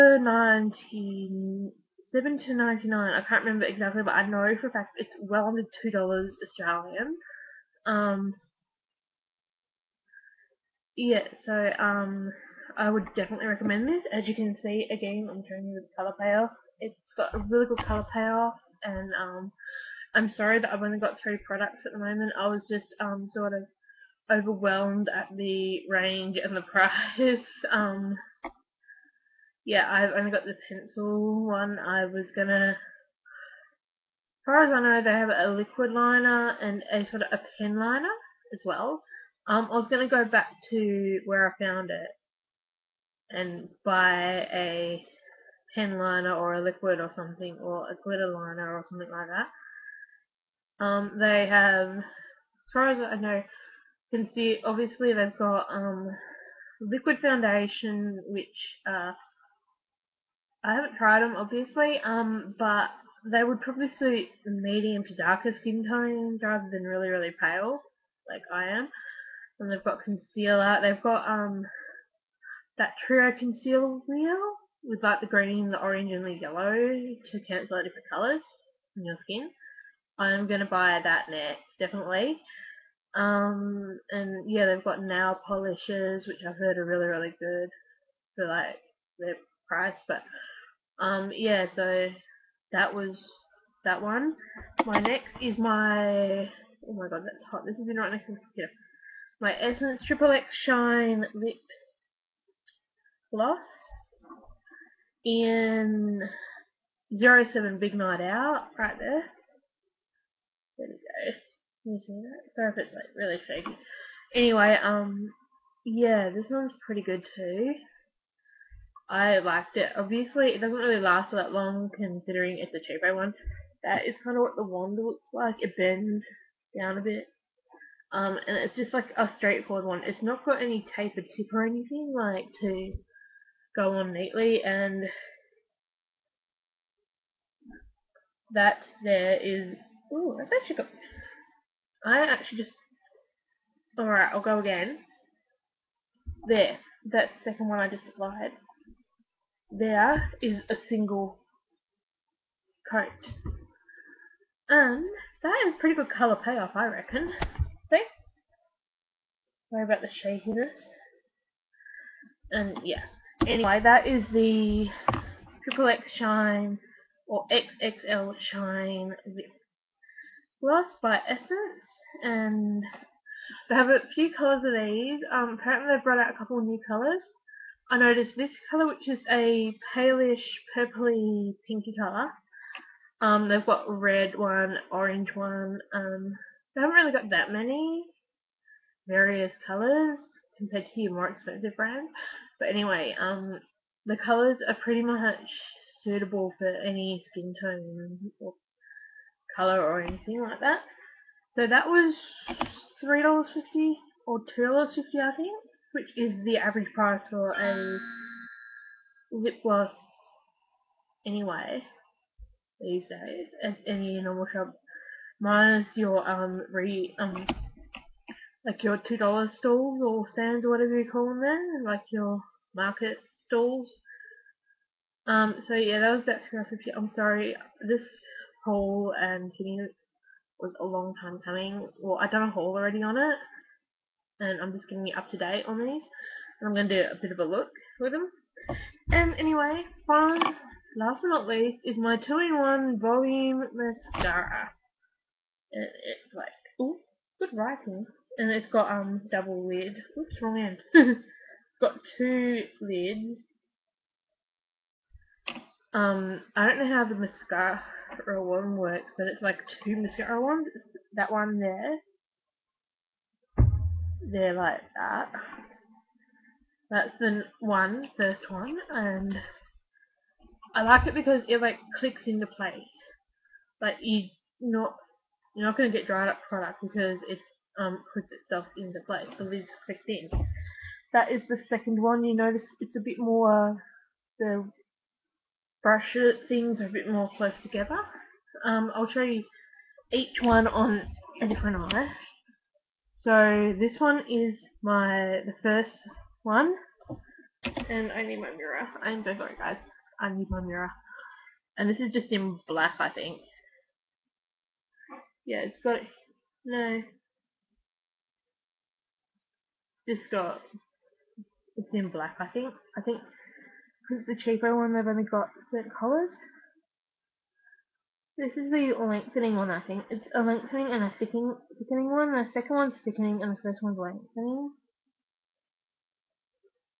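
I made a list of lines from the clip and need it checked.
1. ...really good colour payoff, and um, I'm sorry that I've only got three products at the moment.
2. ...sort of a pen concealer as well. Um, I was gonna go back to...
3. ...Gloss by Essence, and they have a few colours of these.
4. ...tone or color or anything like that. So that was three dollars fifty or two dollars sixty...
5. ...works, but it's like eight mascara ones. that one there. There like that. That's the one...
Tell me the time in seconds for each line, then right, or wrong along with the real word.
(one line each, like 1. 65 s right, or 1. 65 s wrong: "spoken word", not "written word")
1. 17 s right
2. 37 s wrong: "liner", not "concealer"
3. 170 s right
4. 197 s wrong: "fifty", not "sixty"
5. 258 s wrong: "two", not "eight".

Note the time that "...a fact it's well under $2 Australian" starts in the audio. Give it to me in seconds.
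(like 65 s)
4 s.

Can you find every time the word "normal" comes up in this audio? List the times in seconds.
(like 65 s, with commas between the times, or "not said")
214 s.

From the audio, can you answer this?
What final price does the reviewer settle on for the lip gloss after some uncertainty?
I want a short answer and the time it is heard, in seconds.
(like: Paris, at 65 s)
$3.50, at 226 s.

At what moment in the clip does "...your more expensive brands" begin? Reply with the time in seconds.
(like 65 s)
191 s.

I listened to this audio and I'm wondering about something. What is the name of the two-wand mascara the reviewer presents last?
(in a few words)
2-in-1 Volume Mascara.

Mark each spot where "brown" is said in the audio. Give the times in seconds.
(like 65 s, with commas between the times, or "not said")
not said.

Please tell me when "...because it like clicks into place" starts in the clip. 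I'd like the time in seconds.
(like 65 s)
271 s.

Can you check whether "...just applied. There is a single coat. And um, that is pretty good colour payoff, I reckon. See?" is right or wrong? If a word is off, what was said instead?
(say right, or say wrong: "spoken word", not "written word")
right.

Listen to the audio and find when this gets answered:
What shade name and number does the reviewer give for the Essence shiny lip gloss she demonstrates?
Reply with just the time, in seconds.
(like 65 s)
107 s.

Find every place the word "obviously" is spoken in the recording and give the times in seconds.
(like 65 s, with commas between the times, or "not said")
54 s, 61 s, 119 s.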